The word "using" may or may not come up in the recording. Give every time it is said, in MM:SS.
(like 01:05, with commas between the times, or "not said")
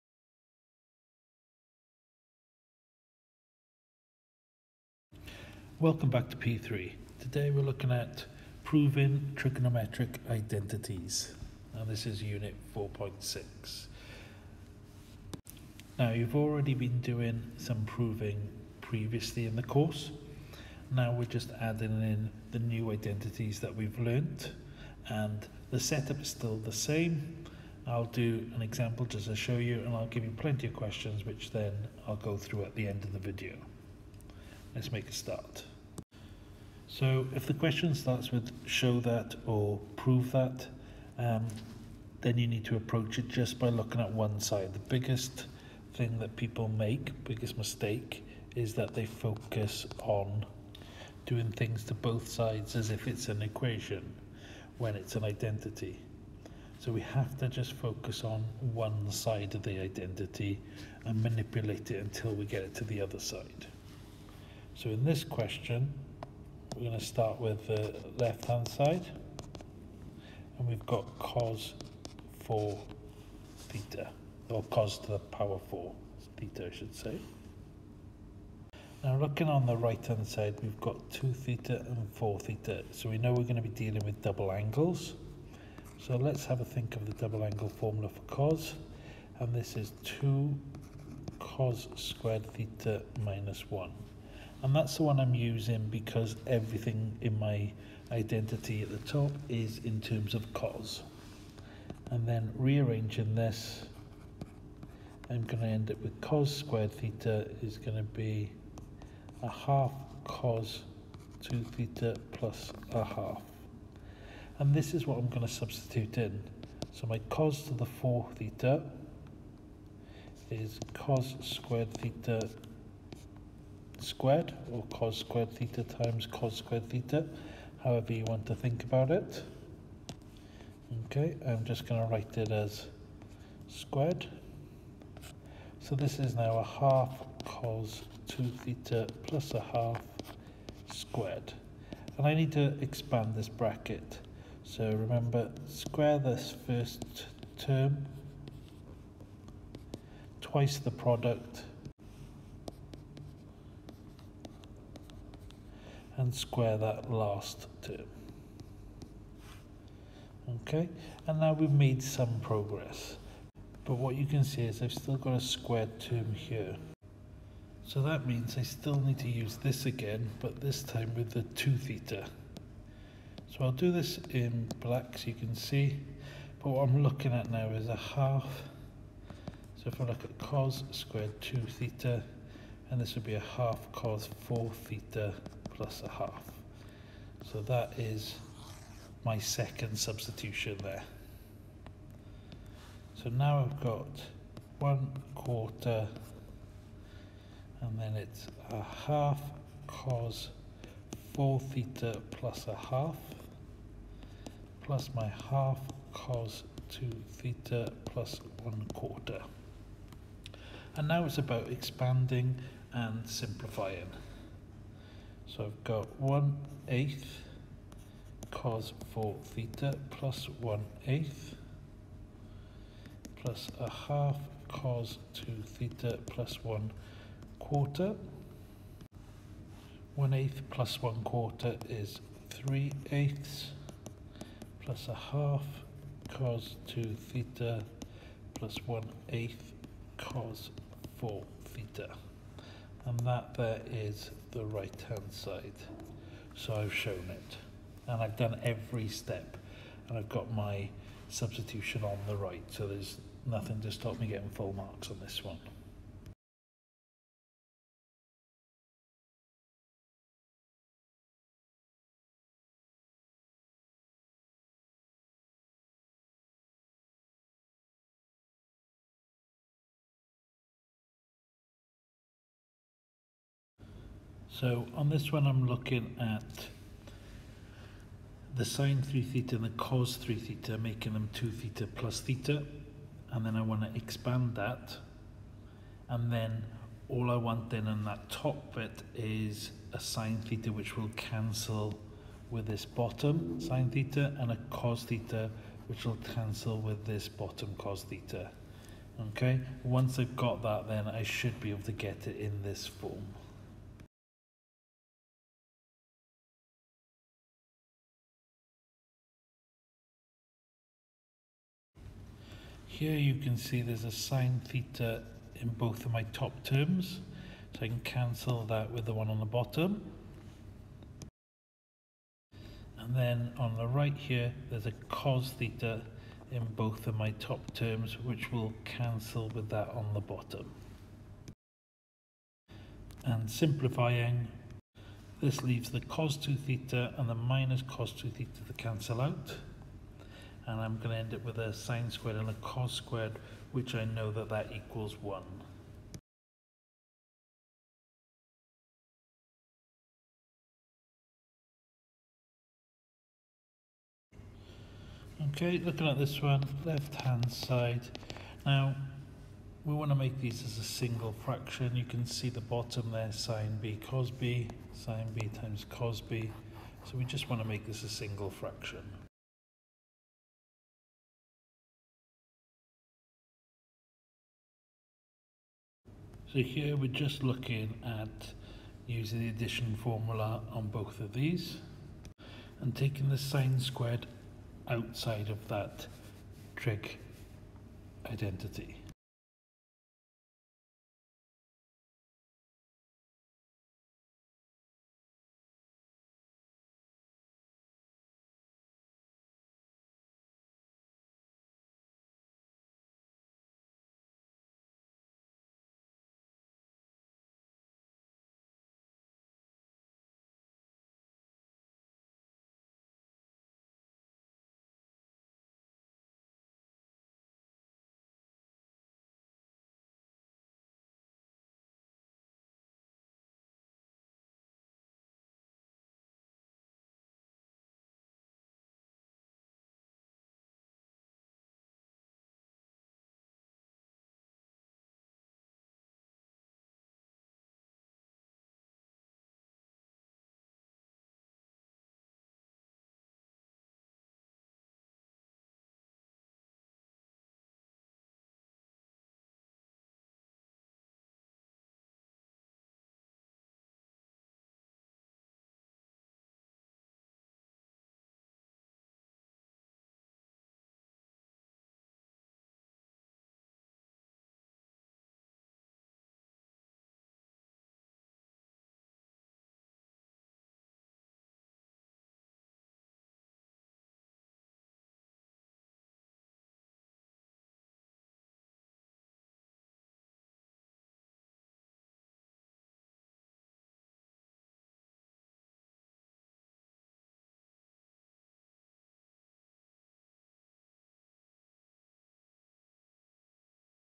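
01:35, 06:19.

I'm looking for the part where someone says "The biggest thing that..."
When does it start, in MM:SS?
00:44.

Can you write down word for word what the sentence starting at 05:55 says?
Okay, looking at this one, left hand side.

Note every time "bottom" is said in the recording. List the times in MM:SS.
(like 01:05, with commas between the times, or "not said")
04:52, 04:57, 05:19, 05:30, 06:02.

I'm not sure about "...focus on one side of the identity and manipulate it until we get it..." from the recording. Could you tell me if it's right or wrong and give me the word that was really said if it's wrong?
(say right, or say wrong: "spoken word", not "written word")
right.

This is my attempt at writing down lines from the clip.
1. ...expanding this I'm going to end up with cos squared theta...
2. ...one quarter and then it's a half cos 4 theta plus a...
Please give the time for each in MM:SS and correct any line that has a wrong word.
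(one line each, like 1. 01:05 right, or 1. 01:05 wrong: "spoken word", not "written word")
1. 01:42 wrong: "rearranging", not "expanding"
2. 03:14 right.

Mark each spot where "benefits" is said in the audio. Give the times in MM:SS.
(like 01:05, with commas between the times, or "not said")
not said.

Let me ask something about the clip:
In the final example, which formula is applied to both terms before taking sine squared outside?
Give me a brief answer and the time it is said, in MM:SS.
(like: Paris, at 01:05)
addition formula, at 06:19.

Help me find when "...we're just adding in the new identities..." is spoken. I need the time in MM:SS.
00:21.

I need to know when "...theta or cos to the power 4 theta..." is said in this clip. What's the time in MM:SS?
01:13.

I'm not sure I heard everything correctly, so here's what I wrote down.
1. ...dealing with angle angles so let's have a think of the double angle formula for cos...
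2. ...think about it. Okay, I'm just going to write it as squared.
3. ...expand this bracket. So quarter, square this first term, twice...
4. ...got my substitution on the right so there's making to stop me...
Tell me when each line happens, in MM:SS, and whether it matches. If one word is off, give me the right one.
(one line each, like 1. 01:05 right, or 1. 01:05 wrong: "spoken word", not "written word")
1. 01:23 wrong: "double", not "angle"
2. 02:08 right
3. 02:22 wrong: "remember", not "quarter"
4. 04:10 wrong: "nothing", not "making".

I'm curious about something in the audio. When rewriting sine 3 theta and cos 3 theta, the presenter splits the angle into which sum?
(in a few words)
2 theta plus theta.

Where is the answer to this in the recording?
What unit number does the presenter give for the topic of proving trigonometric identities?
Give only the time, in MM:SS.
00:12.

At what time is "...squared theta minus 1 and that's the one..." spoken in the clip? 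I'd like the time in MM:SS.
01:31.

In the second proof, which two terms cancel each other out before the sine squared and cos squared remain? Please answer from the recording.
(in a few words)
cos 2 theta and minus cos 2 theta.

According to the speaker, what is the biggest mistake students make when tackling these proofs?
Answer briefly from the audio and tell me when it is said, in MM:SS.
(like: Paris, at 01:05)
doing things to both sides, at 00:51.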